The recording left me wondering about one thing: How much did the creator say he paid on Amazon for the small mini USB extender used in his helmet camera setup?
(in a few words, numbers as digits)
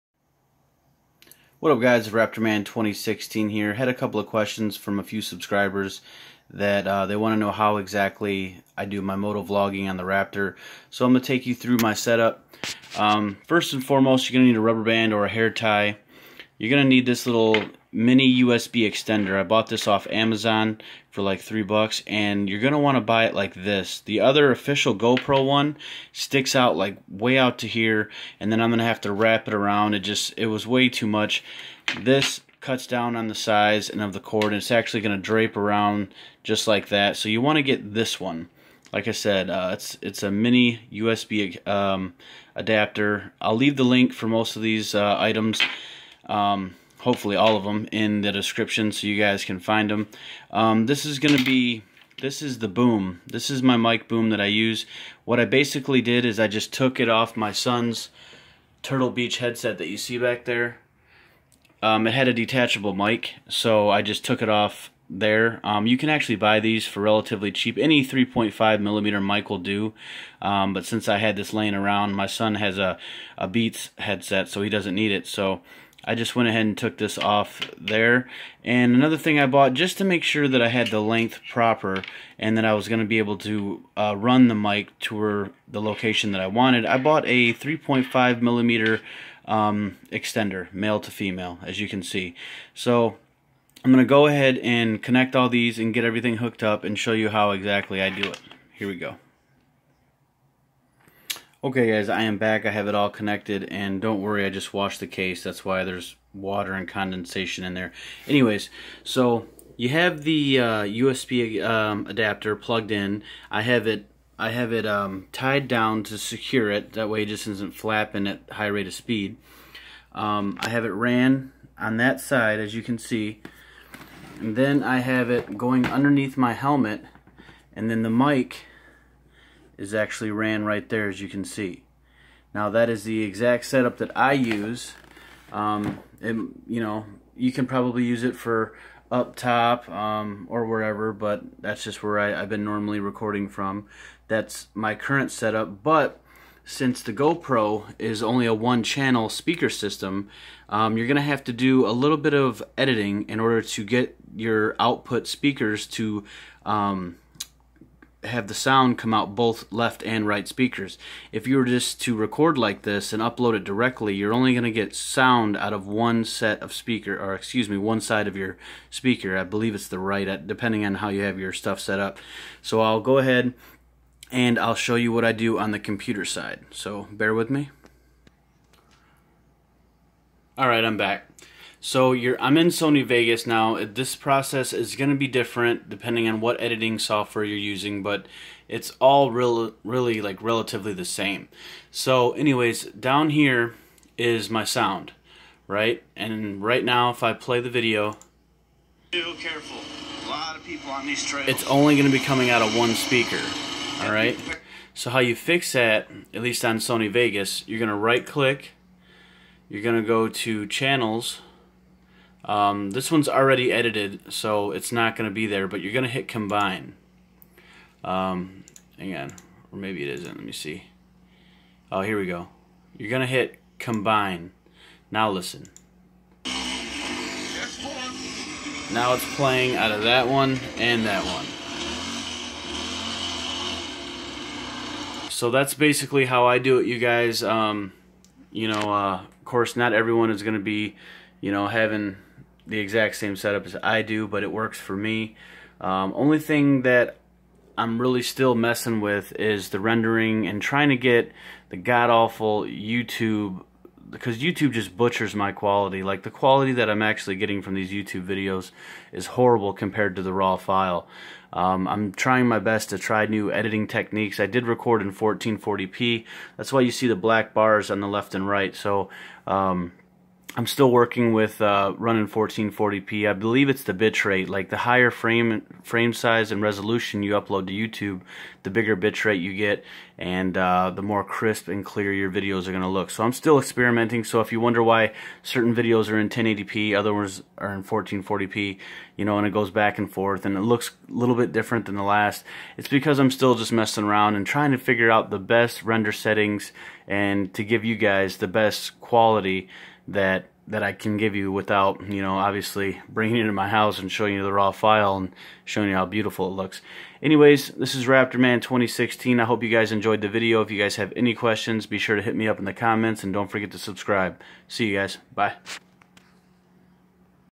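3 dollars.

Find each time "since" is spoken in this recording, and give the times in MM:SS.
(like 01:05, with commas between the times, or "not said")
01:10, 02:26.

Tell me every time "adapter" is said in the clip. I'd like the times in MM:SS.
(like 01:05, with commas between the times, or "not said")
00:42, 01:52.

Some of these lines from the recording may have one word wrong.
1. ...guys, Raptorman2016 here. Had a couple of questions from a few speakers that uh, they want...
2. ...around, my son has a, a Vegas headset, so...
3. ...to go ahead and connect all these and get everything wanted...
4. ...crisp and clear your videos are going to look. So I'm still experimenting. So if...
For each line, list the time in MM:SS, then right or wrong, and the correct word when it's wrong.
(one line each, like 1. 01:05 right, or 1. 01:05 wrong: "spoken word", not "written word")
1. 00:01 wrong: "subscribers", not "speakers"
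2. 01:11 wrong: "Beats", not "Vegas"
3. 01:34 wrong: "hooked", not "wanted"
4. 04:41 right.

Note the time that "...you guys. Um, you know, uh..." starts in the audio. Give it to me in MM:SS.
03:56.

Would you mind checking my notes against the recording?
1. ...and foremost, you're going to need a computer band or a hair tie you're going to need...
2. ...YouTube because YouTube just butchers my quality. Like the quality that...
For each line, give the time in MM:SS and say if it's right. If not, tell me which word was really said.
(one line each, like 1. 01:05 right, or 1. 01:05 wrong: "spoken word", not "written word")
1. 00:13 wrong: "rubber", not "computer"
2. 04:12 right.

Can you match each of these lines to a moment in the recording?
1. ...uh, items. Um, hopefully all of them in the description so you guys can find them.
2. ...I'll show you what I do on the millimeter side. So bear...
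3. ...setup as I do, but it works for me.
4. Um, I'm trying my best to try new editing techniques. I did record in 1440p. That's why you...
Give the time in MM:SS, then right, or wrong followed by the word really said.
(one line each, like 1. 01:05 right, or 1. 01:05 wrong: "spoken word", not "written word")
1. 00:44 right
2. 02:54 wrong: "computer", not "millimeter"
3. 04:03 right
4. 04:21 right.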